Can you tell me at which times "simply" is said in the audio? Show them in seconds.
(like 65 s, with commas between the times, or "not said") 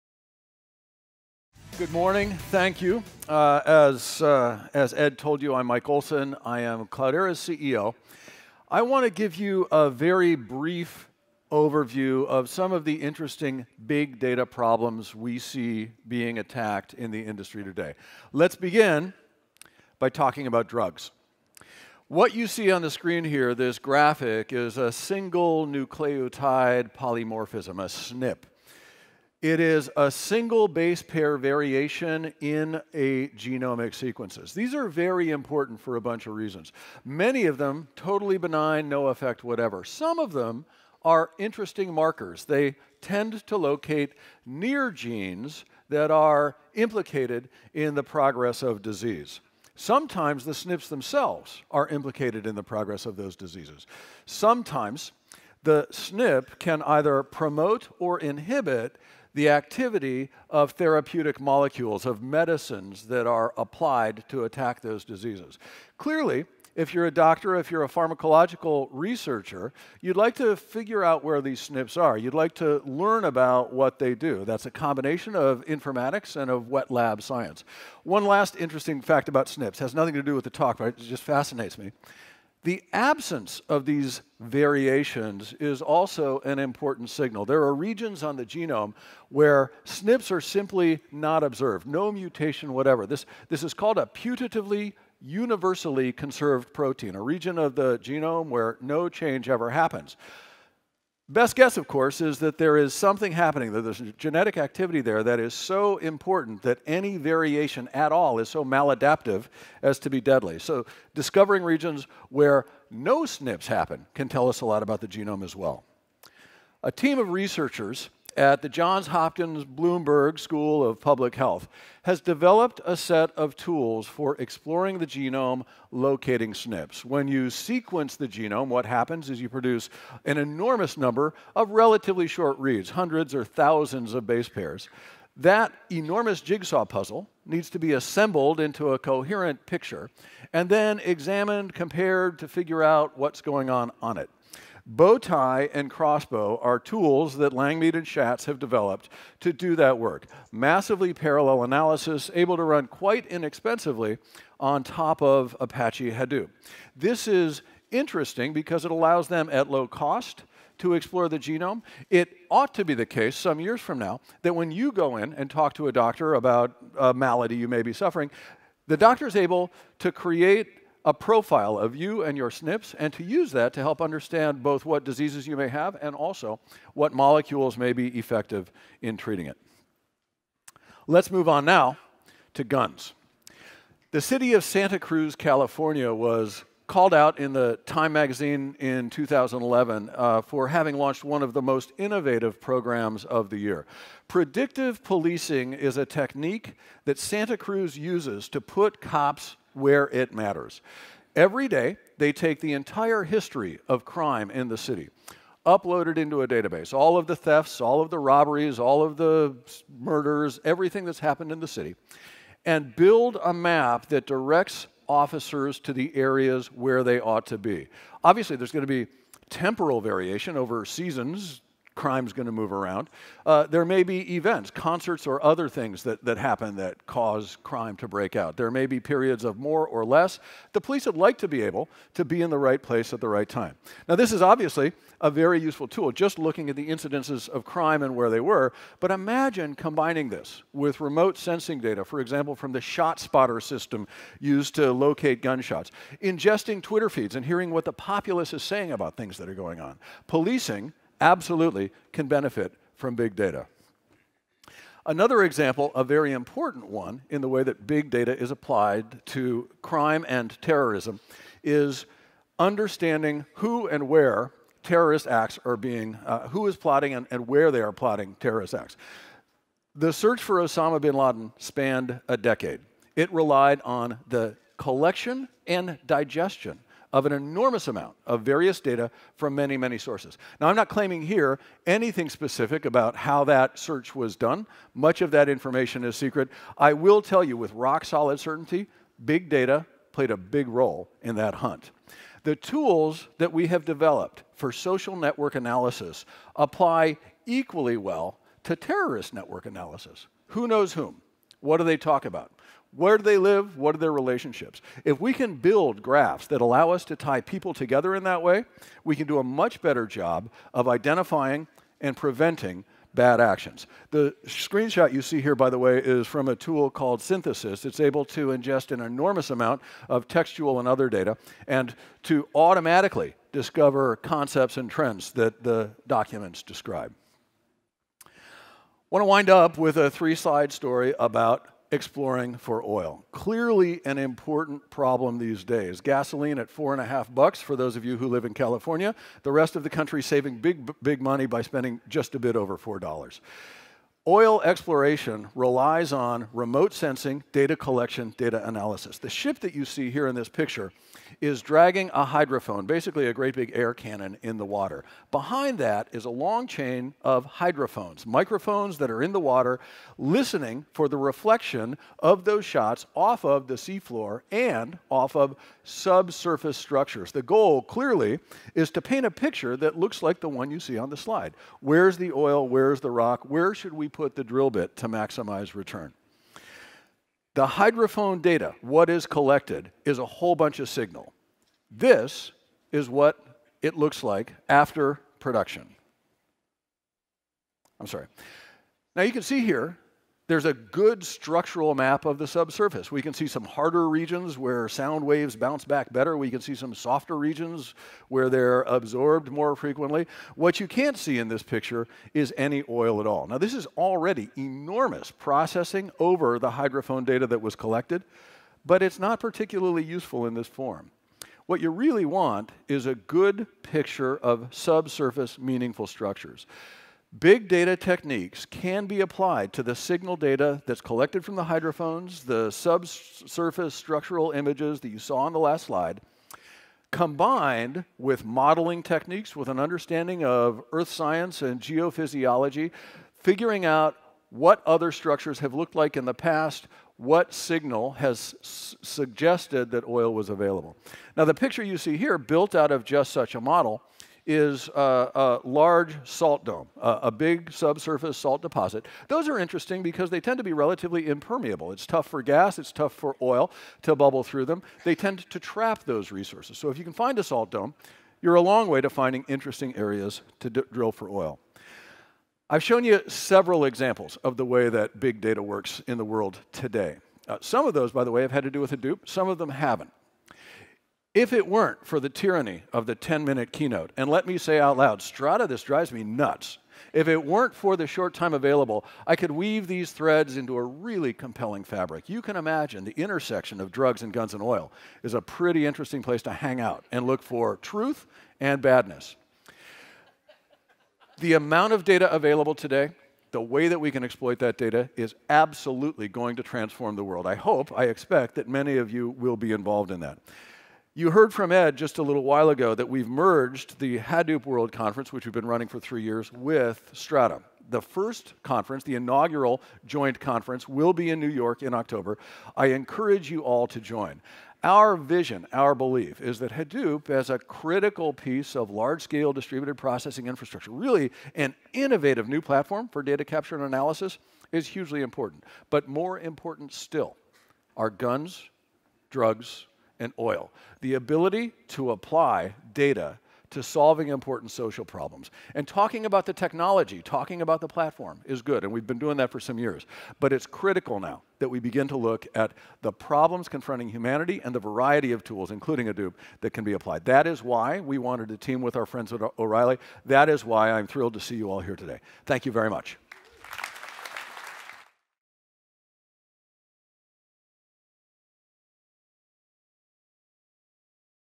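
90 s.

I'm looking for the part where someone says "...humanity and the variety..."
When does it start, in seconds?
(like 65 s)
544 s.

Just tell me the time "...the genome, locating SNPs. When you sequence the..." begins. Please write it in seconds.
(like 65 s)
124 s.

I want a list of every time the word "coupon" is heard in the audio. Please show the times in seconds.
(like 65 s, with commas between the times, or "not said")
not said.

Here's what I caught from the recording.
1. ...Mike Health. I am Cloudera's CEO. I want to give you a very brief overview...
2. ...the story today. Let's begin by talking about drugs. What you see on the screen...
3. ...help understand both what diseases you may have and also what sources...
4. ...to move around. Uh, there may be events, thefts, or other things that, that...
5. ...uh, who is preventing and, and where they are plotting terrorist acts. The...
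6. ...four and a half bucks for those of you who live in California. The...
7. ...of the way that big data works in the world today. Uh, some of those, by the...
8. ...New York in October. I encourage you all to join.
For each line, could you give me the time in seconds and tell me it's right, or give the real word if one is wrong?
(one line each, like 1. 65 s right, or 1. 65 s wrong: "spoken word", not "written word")
1. 5 s wrong: "Olson", not "Health"
2. 17 s wrong: "industry", not "story"
3. 173 s wrong: "molecules", not "sources"
4. 222 s wrong: "concerts", not "thefts"
5. 266 s wrong: "plotting", not "preventing"
6. 336 s right
7. 464 s right
8. 511 s right.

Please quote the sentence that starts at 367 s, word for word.
The goal, clearly, is to paint a picture that looks like the one you see on the slide.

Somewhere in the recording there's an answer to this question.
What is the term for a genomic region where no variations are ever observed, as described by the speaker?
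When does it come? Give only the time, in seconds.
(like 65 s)
94 s.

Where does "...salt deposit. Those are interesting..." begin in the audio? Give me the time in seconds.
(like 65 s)
448 s.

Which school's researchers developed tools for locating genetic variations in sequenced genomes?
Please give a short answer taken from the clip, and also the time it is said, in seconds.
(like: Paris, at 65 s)
Johns Hopkins Bloomberg School of Public Health, at 118 s.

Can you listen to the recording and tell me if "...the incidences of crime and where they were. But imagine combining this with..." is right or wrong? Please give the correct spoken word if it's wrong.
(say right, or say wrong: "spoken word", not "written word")
right.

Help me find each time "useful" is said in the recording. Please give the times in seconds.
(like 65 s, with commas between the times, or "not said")
235 s, 410 s.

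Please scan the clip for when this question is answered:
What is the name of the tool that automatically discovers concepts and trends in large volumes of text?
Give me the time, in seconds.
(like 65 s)
317 s.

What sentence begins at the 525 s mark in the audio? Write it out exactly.
But more important still are guns, drugs, and oil.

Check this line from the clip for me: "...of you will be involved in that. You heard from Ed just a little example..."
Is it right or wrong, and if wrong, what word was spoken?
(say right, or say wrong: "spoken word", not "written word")
wrong: "while", not "example".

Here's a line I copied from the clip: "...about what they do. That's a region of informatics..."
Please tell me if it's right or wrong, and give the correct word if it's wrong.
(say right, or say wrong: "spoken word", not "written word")
wrong: "combination", not "region".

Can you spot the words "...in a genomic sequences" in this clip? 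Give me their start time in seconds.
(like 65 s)
32 s.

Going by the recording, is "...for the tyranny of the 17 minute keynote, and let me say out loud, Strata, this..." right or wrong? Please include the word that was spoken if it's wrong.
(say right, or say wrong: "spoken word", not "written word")
wrong: "10", not "17".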